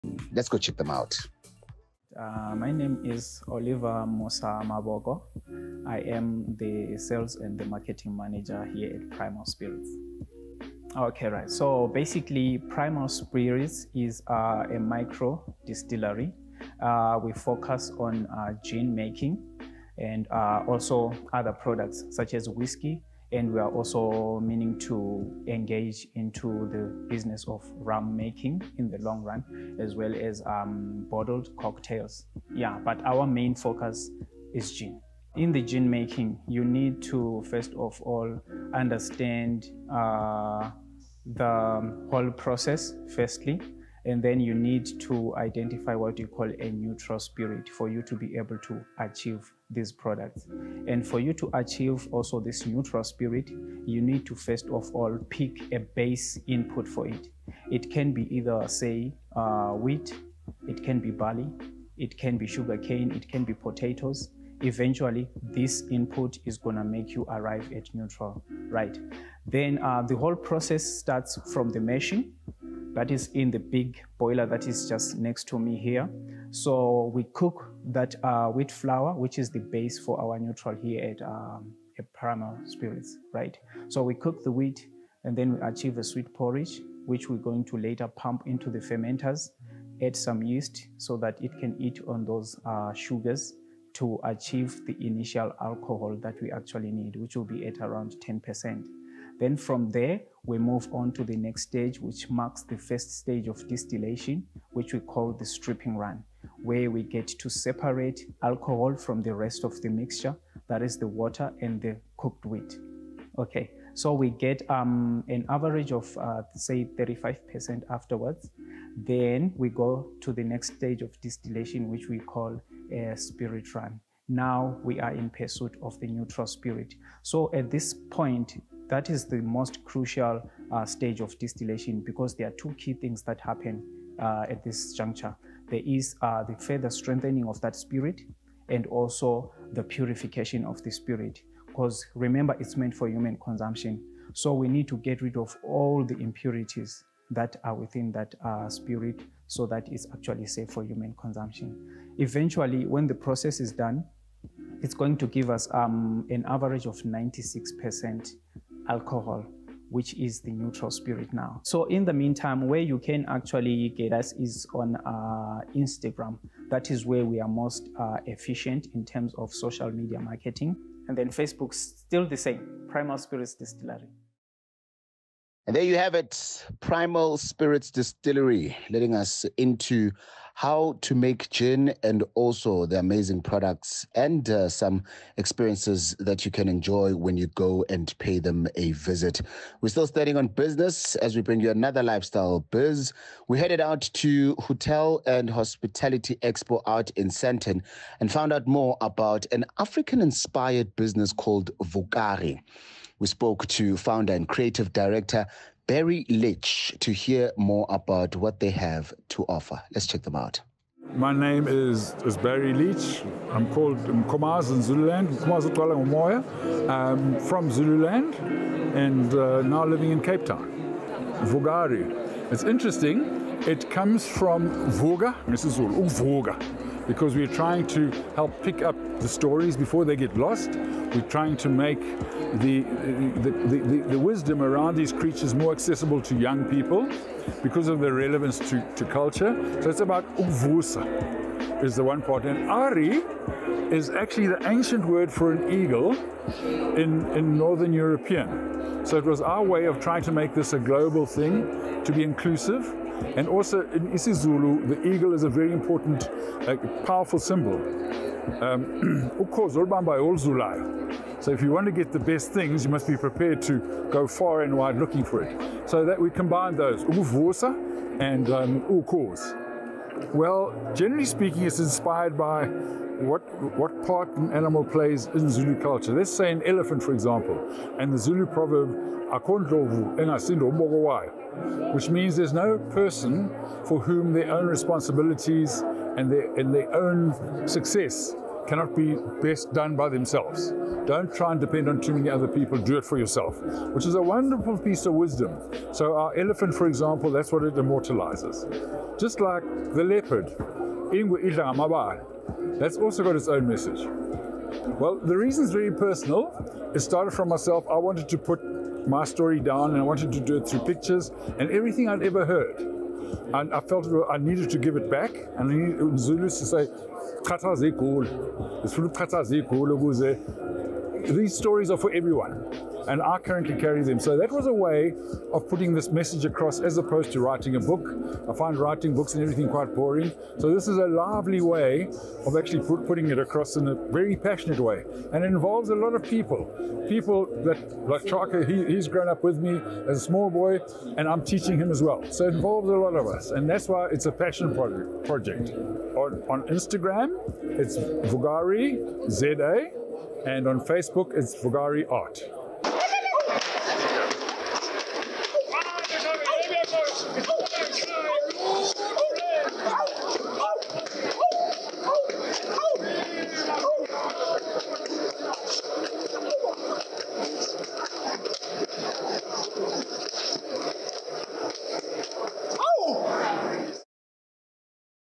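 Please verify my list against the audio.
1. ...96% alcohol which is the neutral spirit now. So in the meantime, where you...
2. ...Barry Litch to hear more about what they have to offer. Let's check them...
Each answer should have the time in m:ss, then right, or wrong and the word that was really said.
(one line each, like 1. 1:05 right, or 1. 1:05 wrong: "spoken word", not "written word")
1. 2:37 right
2. 3:25 right.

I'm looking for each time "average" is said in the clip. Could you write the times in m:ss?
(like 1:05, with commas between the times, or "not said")
1:55, 2:36.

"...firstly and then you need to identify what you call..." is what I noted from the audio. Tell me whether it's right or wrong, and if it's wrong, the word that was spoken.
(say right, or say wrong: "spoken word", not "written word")
right.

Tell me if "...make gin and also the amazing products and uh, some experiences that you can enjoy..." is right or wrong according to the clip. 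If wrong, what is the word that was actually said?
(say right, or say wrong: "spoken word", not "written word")
right.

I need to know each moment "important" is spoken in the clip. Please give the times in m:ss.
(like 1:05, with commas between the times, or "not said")
4:15.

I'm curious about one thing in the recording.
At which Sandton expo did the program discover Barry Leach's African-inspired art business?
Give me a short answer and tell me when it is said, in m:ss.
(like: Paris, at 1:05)
Hotel and Hospitality Expo, at 3:14.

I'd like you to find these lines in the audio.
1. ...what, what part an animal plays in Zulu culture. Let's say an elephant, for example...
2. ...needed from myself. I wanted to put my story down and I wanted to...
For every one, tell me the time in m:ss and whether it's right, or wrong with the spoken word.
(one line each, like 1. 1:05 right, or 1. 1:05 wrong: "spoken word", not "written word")
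1. 4:32 right
2. 5:06 wrong: "started", not "needed".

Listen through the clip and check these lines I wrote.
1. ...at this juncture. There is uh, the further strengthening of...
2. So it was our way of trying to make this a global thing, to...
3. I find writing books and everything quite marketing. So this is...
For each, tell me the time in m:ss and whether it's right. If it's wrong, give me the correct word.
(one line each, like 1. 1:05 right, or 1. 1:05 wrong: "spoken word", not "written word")
1. 2:14 right
2. 4:09 right
3. 5:28 wrong: "boring", not "marketing".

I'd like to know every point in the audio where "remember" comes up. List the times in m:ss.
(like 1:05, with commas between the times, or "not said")
2:22.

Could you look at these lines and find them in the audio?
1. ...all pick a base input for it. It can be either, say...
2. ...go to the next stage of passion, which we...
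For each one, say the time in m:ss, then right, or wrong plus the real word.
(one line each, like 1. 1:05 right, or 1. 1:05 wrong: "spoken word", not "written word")
1. 0:54 right
2. 1:59 wrong: "distillation", not "passion".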